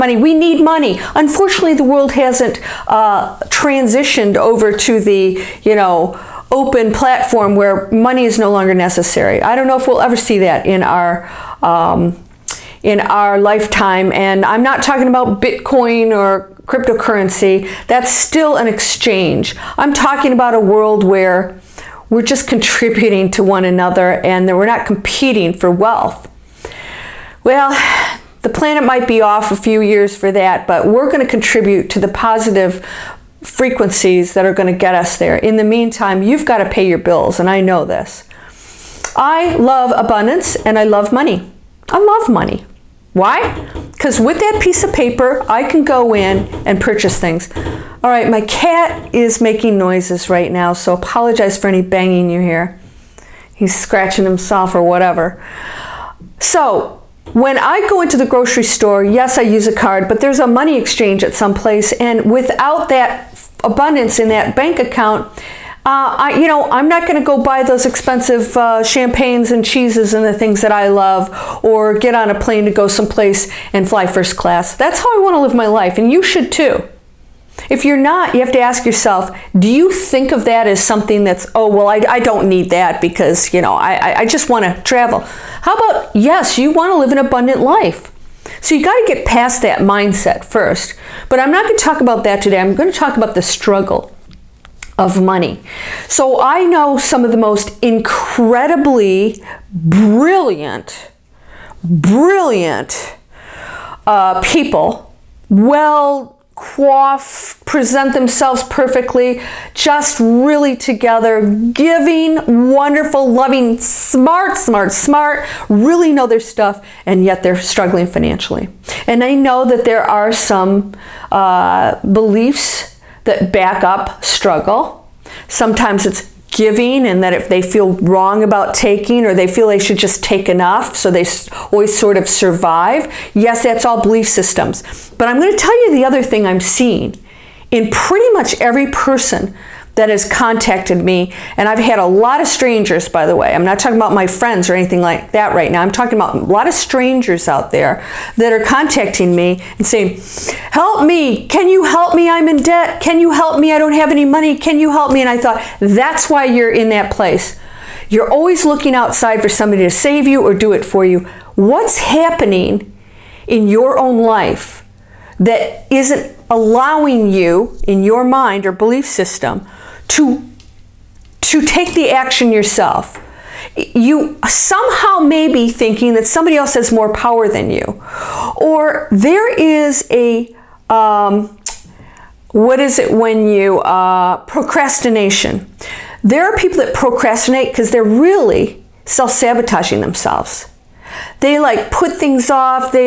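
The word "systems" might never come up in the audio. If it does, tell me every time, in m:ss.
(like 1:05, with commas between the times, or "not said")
2:14, 2:49.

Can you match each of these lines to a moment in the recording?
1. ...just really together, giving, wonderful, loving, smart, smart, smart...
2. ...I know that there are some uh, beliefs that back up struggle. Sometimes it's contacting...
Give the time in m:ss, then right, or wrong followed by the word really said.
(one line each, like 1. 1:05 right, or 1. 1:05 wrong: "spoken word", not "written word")
1. 1:49 right
2. 1:59 wrong: "giving", not "contacting".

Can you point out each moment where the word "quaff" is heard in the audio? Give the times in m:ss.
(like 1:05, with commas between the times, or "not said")
1:46.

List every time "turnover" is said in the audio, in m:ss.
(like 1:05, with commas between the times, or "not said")
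not said.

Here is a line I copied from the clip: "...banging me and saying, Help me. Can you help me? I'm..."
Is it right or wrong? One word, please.
wrong.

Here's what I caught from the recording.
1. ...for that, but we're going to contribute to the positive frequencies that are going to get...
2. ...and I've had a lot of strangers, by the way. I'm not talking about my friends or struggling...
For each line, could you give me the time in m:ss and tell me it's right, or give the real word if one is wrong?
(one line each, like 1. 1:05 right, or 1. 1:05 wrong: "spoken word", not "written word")
1. 0:30 right
2. 2:21 wrong: "anything", not "struggling".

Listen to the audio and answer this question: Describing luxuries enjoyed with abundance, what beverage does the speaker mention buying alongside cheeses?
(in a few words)
champagnes.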